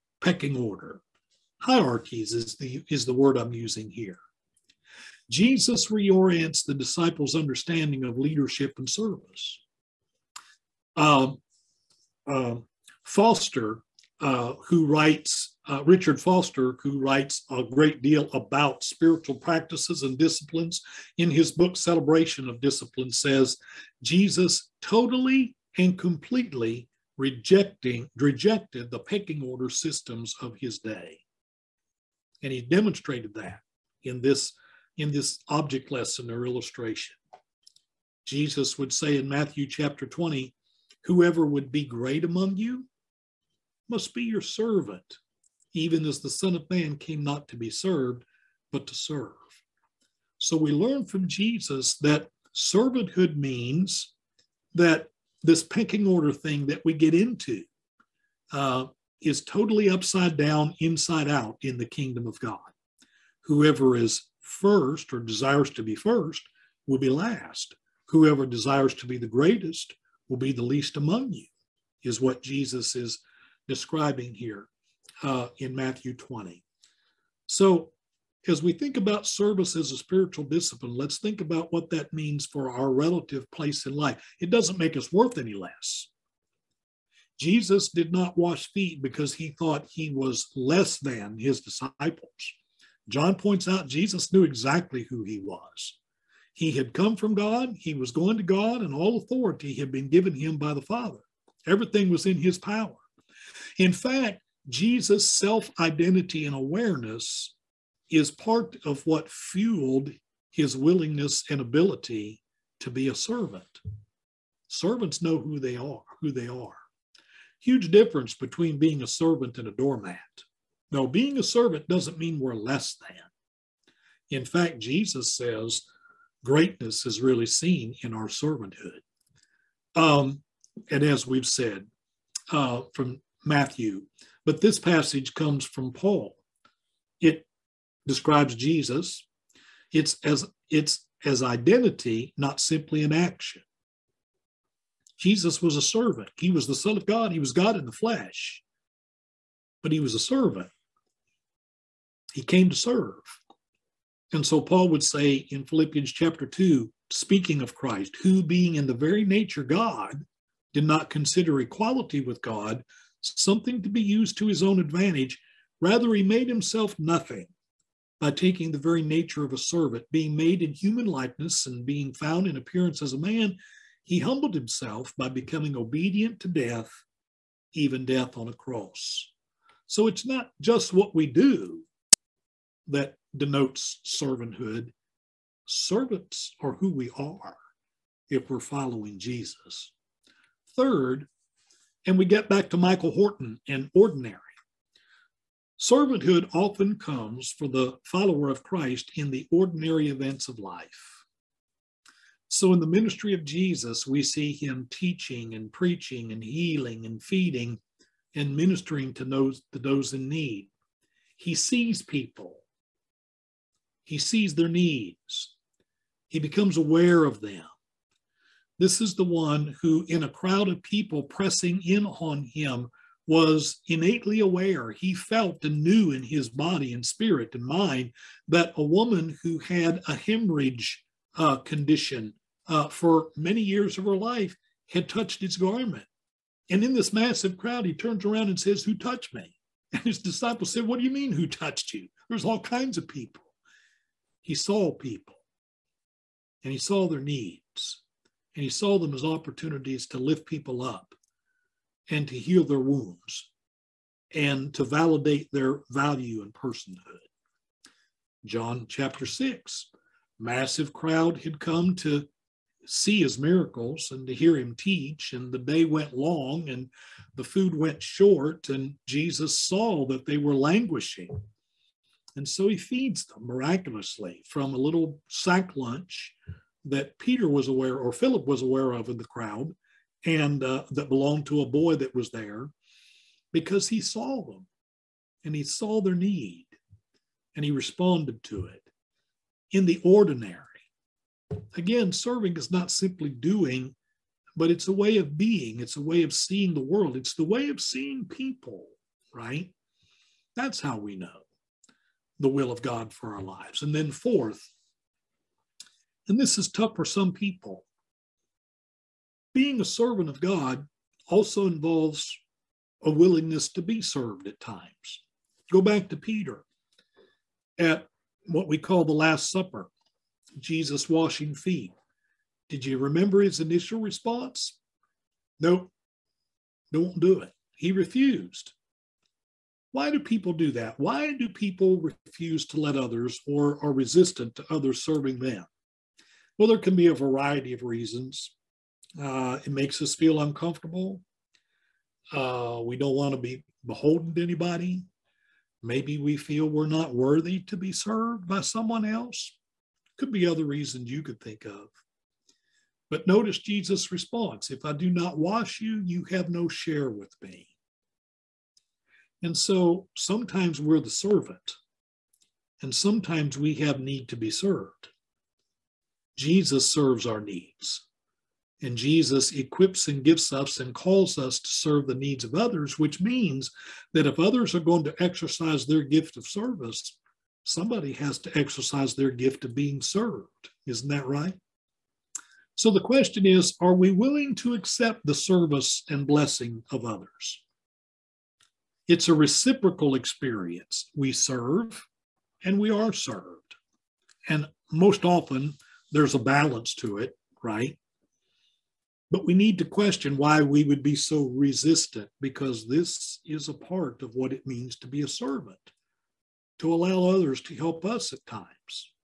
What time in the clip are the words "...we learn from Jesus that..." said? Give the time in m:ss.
0:50.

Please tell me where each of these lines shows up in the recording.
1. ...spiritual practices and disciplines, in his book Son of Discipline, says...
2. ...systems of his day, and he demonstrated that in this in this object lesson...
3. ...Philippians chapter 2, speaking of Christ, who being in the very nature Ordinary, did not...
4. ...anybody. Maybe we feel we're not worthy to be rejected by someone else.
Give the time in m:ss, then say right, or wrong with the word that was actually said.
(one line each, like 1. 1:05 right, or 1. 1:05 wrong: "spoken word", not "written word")
1. 0:18 wrong: "Celebration", not "Son"
2. 0:29 right
3. 2:35 wrong: "God", not "Ordinary"
4. 5:44 wrong: "served", not "rejected".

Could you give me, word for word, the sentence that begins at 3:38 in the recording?
This is the one who, in a crowd of people pressing in on him, was innately aware.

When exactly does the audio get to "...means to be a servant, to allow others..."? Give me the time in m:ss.
6:44.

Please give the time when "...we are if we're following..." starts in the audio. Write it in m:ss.
3:06.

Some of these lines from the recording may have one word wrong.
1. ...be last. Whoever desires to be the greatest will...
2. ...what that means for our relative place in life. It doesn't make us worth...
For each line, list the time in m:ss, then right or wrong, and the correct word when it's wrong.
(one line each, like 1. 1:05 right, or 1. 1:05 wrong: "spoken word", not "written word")
1. 1:06 right
2. 1:21 right.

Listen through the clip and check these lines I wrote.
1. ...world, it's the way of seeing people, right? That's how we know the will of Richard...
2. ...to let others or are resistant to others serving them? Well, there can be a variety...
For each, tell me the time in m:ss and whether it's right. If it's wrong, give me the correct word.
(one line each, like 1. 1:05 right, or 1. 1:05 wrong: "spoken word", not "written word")
1. 4:56 wrong: "God", not "Richard"
2. 5:32 right.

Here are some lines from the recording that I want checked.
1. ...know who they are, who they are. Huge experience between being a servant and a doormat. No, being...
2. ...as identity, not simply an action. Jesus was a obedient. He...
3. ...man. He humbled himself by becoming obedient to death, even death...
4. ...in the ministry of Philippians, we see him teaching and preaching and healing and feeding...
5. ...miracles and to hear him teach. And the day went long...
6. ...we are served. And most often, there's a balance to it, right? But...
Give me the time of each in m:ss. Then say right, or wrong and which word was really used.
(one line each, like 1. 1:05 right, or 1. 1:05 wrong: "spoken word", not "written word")
1. 1:55 wrong: "difference", not "experience"
2. 2:21 wrong: "servant", not "obedient"
3. 2:53 right
4. 3:22 wrong: "Jesus", not "Philippians"
5. 4:23 right
6. 6:32 right.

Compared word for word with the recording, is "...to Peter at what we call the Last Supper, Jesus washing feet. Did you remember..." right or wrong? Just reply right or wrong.
right.